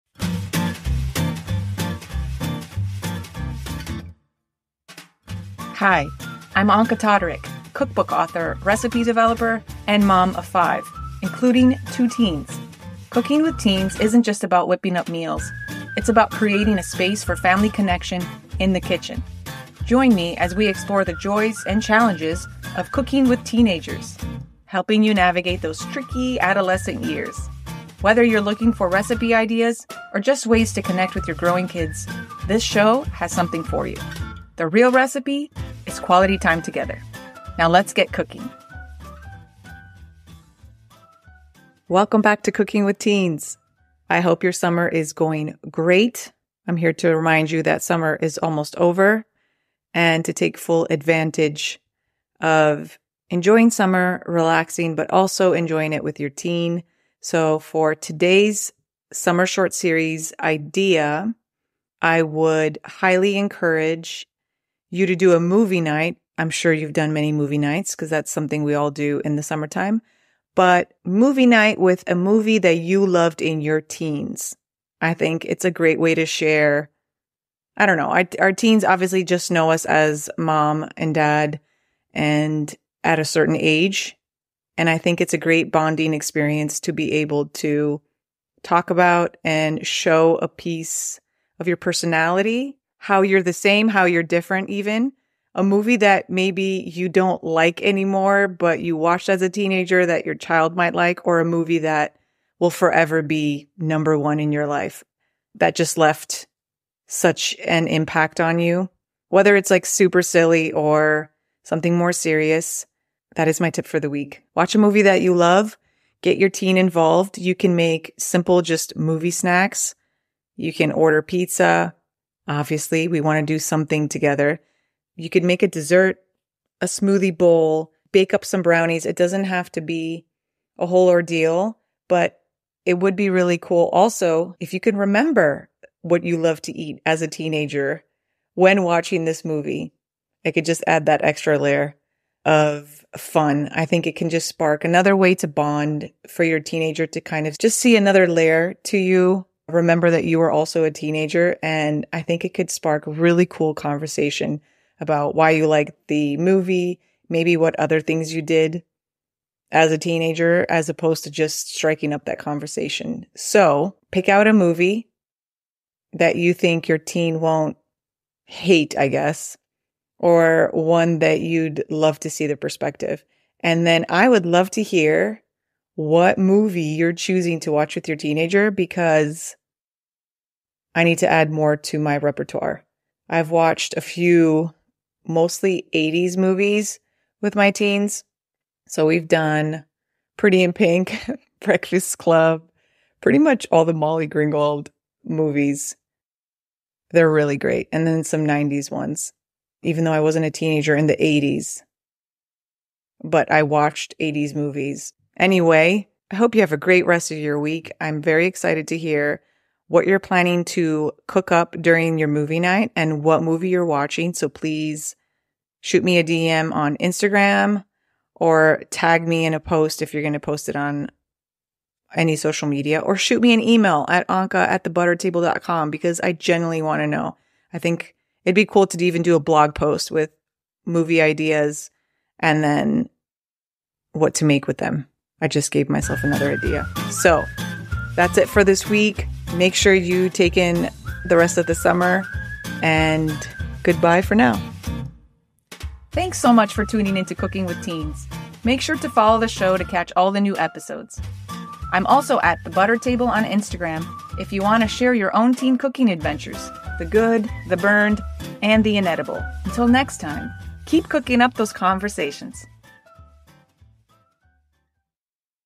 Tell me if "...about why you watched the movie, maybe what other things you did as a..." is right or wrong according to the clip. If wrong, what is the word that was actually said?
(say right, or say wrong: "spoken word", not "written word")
wrong: "liked", not "watched".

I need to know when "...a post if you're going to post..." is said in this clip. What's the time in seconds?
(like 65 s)
219 s.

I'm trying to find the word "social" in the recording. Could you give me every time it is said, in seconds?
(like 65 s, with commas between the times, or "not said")
222 s.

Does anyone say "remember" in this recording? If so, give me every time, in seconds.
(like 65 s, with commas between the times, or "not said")
134 s, 149 s.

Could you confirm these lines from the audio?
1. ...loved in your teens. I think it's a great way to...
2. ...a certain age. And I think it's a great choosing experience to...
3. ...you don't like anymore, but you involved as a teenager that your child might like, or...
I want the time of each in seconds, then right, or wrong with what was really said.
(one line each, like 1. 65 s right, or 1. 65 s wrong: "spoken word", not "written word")
1. 73 s right
2. 83 s wrong: "bonding", not "choosing"
3. 96 s wrong: "watched", not "involved".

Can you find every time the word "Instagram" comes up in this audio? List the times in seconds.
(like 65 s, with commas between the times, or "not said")
216 s, 253 s.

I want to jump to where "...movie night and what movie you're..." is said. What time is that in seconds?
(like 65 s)
212 s.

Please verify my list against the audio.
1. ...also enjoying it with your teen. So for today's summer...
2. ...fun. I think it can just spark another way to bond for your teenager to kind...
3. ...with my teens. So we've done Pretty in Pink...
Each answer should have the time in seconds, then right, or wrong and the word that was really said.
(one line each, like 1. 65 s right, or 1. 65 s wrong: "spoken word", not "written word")
1. 55 s right
2. 143 s right
3. 187 s right.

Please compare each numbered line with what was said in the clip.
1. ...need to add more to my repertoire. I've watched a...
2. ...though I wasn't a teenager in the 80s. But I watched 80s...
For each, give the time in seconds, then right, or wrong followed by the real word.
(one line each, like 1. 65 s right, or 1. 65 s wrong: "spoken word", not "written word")
1. 181 s right
2. 200 s right.